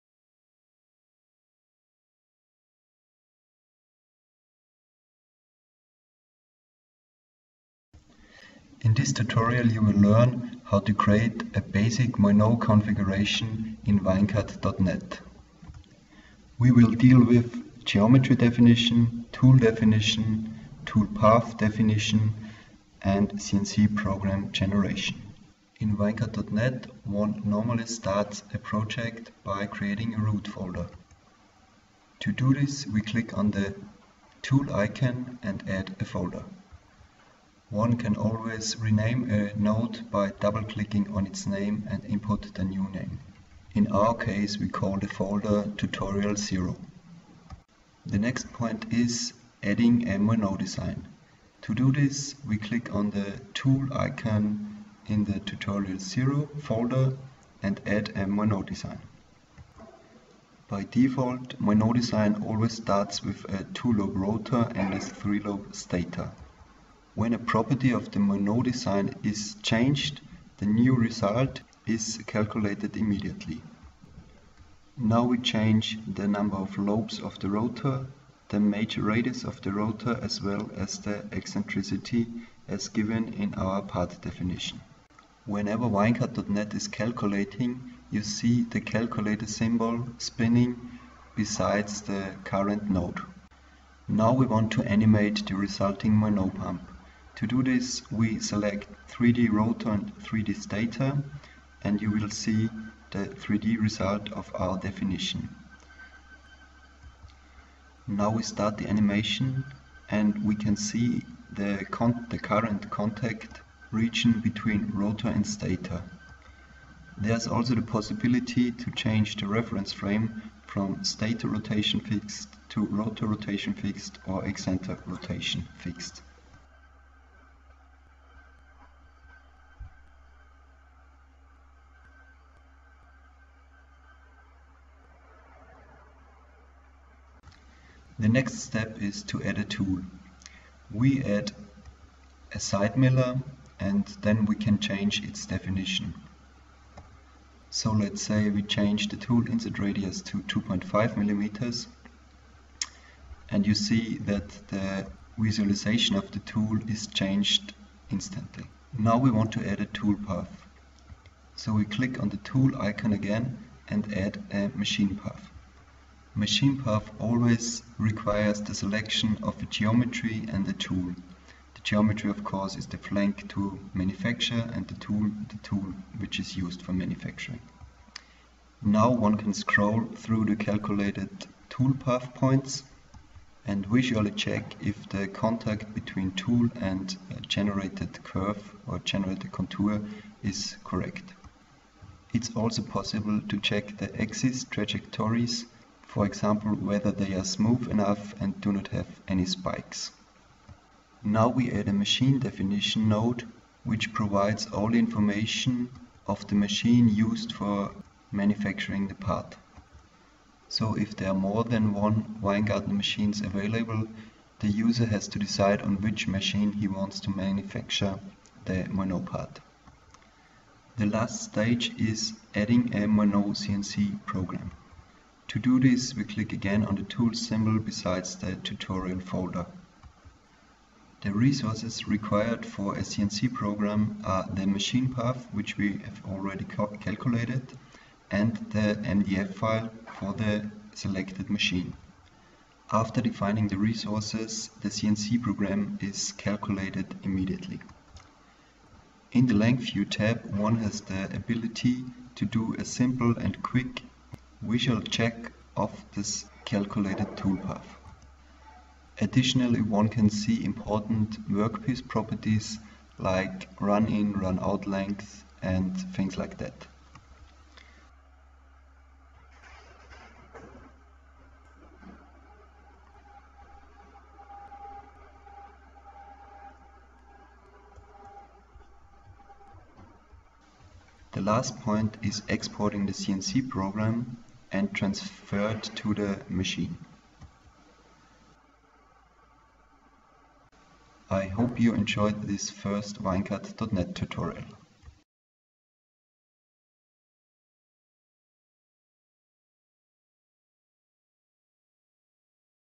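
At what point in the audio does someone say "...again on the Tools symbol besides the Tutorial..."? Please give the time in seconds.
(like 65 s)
226 s.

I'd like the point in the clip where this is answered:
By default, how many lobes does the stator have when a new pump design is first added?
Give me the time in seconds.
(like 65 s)
64 s.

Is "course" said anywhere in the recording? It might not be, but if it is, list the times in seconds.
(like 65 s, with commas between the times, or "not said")
172 s.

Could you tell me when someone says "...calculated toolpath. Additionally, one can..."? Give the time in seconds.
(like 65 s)
256 s.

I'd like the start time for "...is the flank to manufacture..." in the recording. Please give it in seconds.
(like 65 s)
172 s.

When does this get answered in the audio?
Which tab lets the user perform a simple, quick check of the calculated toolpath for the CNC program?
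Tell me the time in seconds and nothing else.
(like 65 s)
249 s.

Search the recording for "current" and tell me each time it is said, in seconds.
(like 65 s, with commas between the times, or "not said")
92 s, 112 s.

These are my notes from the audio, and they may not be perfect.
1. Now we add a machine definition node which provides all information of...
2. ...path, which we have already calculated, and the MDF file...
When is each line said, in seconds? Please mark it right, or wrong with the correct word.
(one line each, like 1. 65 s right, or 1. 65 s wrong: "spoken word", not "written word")
1. 201 s right
2. 235 s right.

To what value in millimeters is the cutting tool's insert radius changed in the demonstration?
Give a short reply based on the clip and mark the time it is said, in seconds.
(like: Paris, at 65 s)
2.5 millimeters, at 150 s.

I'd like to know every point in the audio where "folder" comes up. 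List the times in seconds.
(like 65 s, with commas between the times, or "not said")
30 s, 36 s, 45 s, 56 s, 229 s.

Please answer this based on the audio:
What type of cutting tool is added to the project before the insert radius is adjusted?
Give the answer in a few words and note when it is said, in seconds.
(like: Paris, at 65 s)
side miller, at 142 s.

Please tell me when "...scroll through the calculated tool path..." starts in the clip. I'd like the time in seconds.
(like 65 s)
179 s.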